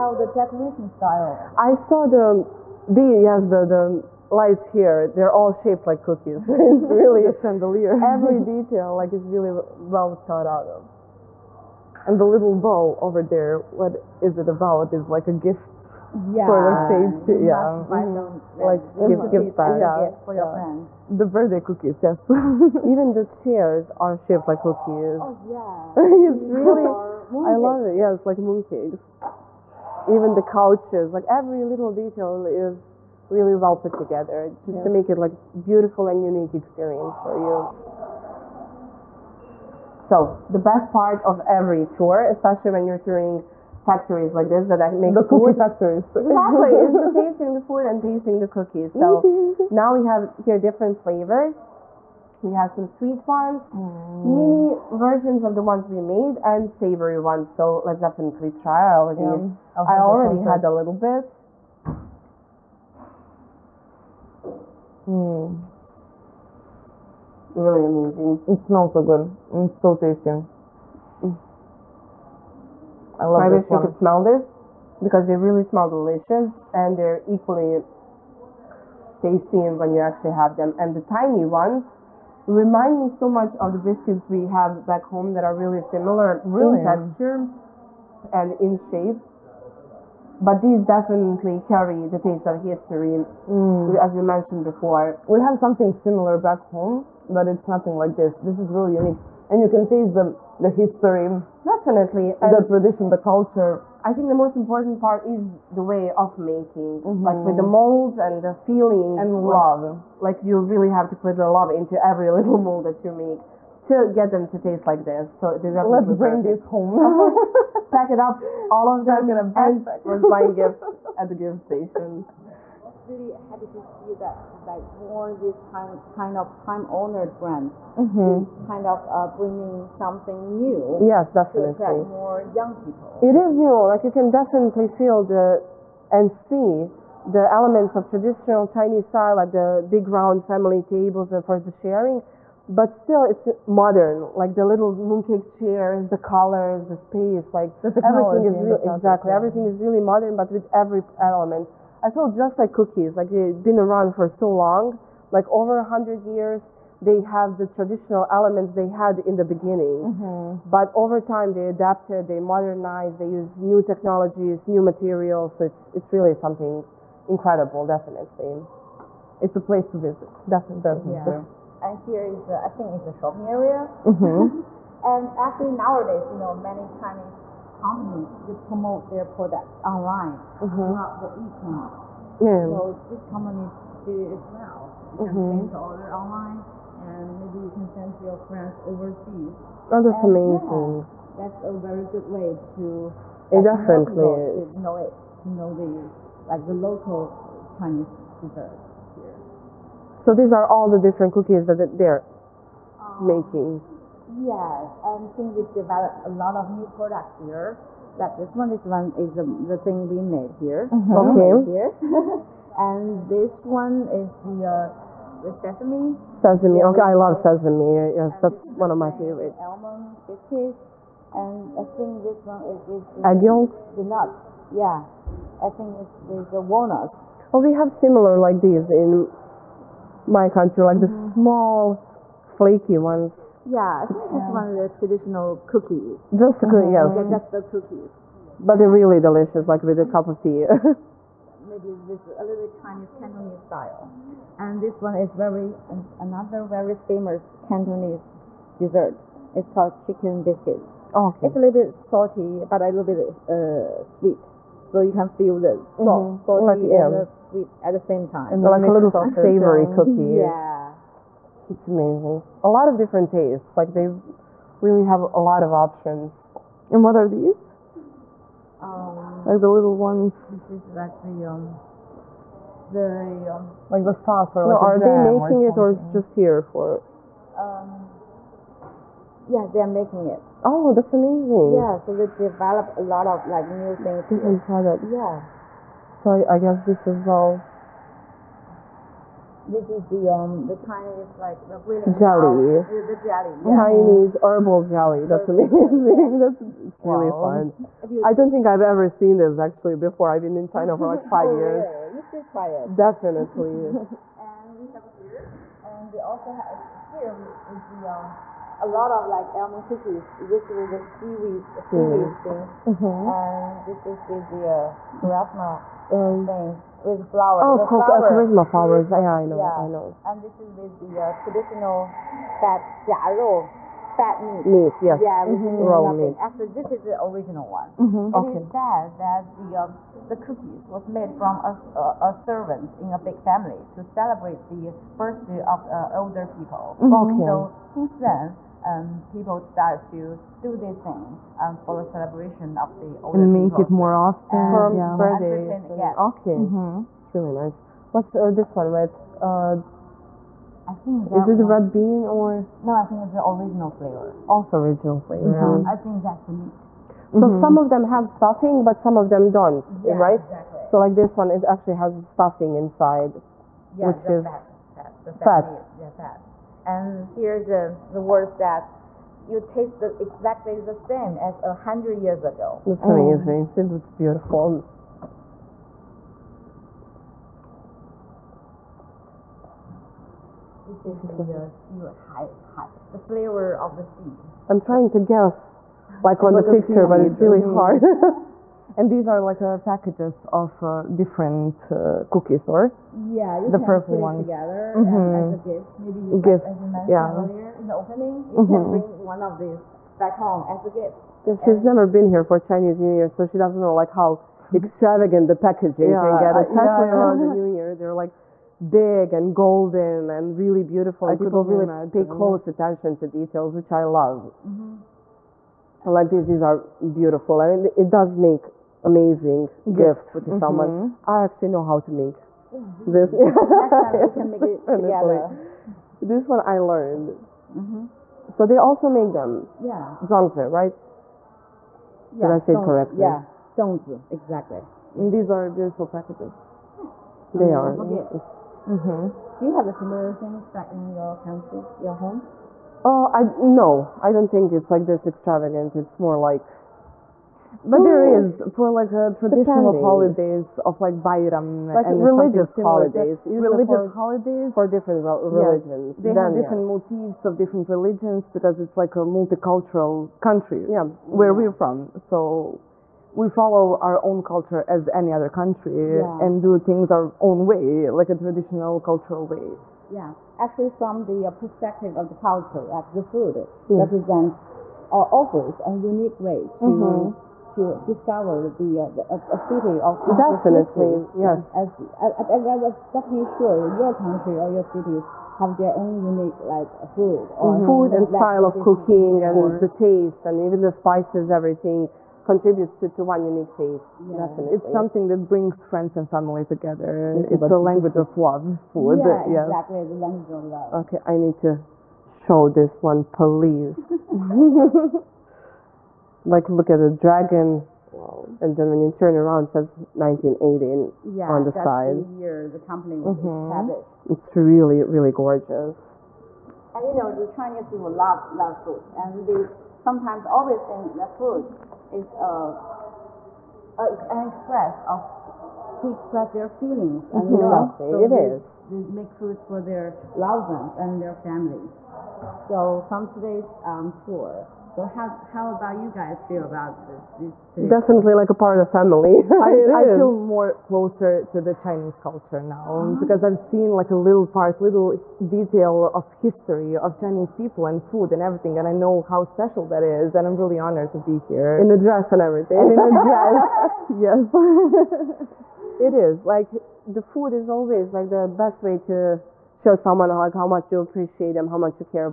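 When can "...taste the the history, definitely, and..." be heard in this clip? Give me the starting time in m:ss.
1:39.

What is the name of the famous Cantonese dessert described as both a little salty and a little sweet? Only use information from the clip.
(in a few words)
chicken biscuit.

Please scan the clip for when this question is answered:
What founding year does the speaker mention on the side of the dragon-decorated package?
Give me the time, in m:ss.
8:30.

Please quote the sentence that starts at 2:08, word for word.
kind of uh, bringing something new.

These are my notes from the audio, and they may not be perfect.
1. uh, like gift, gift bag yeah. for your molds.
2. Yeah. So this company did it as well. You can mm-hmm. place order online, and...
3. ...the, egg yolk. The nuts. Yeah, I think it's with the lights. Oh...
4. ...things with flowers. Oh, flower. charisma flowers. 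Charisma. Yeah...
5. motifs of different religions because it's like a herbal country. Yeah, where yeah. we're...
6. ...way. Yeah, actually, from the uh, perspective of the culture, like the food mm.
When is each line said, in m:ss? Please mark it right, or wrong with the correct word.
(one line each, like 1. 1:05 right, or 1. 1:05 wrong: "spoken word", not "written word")
1. 0:18 wrong: "friends", not "molds"
2. 3:02 right
3. 3:43 wrong: "walnuts", not "lights"
4. 5:16 right
5. 7:37 wrong: "multicultural", not "herbal"
6. 7:49 right.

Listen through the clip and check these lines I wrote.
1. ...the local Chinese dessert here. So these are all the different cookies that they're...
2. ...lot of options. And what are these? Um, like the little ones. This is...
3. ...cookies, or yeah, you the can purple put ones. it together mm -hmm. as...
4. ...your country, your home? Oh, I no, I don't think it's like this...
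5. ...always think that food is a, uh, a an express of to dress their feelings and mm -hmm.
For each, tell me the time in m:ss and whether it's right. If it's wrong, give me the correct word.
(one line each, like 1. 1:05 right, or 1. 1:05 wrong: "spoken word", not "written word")
1. 3:16 right
2. 4:25 right
3. 6:32 right
4. 7:21 right
5. 8:40 wrong: "express", not "dress".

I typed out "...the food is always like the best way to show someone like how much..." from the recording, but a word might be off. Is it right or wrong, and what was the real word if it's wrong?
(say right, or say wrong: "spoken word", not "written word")
right.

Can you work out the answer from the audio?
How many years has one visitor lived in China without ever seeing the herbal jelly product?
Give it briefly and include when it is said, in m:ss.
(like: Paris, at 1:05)
5 years, at 5:01.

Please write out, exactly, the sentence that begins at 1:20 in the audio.
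And the tiny ones remind me so much of the biscuits we have back home that are really similar really?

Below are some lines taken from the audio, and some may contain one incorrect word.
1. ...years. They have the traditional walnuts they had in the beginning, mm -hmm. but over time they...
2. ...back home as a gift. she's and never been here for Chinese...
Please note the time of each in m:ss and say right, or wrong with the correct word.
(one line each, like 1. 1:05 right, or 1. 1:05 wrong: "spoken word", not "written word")
1. 2:36 wrong: "elements", not "walnuts"
2. 6:40 right.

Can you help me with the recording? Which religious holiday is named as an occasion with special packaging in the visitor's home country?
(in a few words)
Bayram.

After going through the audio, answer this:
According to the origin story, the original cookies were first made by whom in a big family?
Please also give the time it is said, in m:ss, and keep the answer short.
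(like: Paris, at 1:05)
a servant, at 5:32.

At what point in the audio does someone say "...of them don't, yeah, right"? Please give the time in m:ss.
5:59.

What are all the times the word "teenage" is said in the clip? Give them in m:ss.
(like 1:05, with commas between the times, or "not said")
not said.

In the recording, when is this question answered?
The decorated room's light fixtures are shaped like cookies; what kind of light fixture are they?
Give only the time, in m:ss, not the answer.
0:07.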